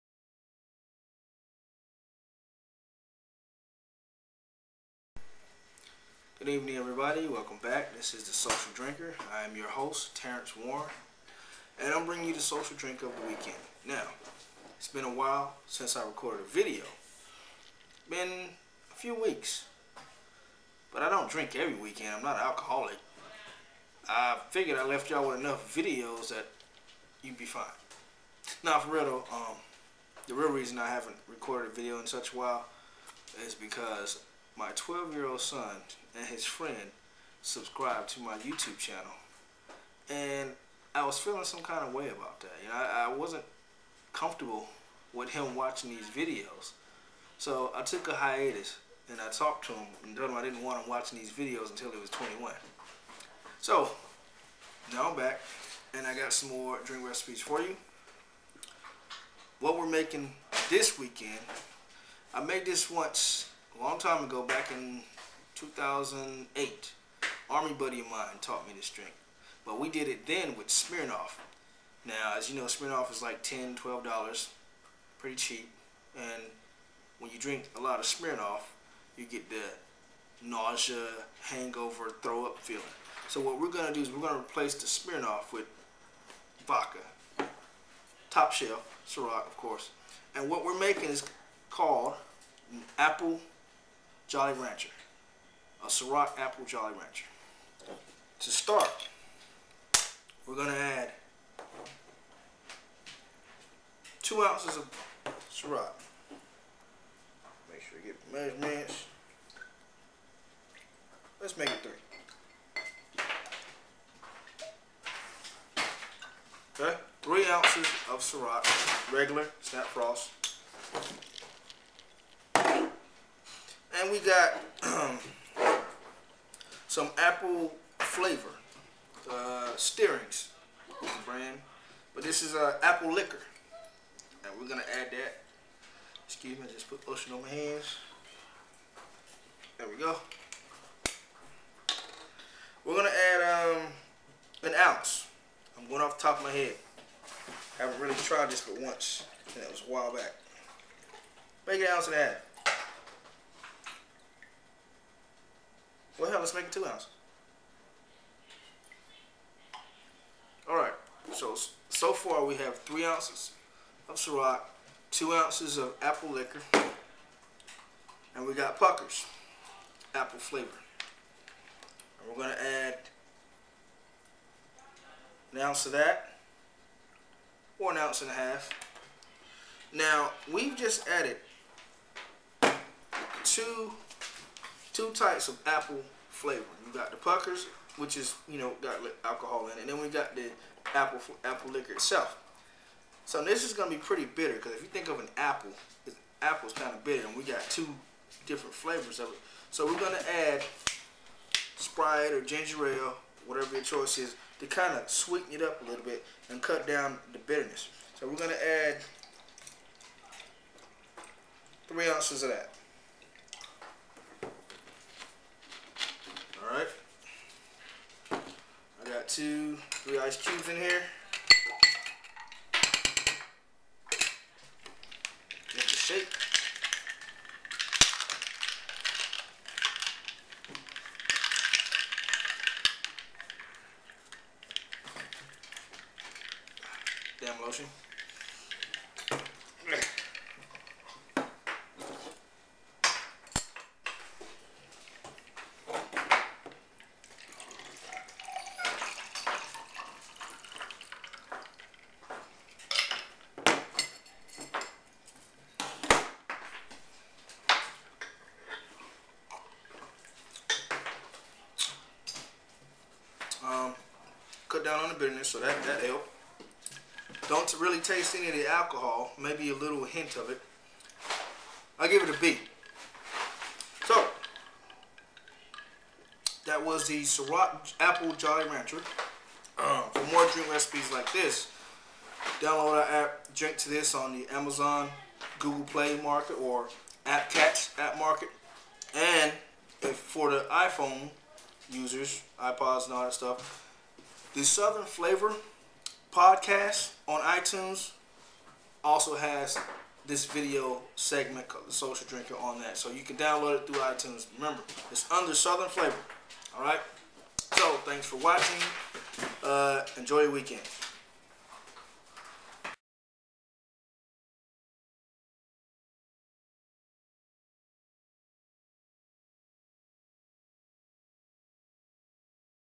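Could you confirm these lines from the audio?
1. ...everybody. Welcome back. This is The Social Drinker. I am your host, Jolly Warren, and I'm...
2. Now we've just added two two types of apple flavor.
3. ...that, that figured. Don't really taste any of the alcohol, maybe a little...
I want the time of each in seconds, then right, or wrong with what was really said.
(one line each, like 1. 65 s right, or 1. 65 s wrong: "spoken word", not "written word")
1. 6 s wrong: "Terrence", not "Jolly"
2. 179 s right
3. 265 s wrong: "helped", not "figured".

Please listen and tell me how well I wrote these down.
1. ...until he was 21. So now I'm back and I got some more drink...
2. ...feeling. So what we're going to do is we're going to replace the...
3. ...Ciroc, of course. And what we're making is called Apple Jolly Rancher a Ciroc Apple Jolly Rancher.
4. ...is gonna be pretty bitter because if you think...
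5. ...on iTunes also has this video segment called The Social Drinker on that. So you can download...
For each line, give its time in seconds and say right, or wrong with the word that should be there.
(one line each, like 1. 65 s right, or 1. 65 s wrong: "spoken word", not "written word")
1. 51 s right
2. 82 s right
3. 89 s right
4. 193 s right
5. 297 s right.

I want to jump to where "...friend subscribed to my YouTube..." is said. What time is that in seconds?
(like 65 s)
36 s.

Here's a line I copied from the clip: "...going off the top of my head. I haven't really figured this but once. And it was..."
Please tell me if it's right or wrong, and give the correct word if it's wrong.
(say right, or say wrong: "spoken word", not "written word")
wrong: "tried", not "figured".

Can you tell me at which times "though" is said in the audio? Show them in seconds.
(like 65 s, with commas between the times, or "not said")
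29 s.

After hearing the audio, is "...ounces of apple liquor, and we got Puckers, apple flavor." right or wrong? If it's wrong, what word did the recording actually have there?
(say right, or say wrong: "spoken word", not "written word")
right.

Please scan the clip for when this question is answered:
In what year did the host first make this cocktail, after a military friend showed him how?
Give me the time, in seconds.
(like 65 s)
65 s.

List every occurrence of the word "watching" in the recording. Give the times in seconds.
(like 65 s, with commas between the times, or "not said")
45 s, 50 s, 308 s.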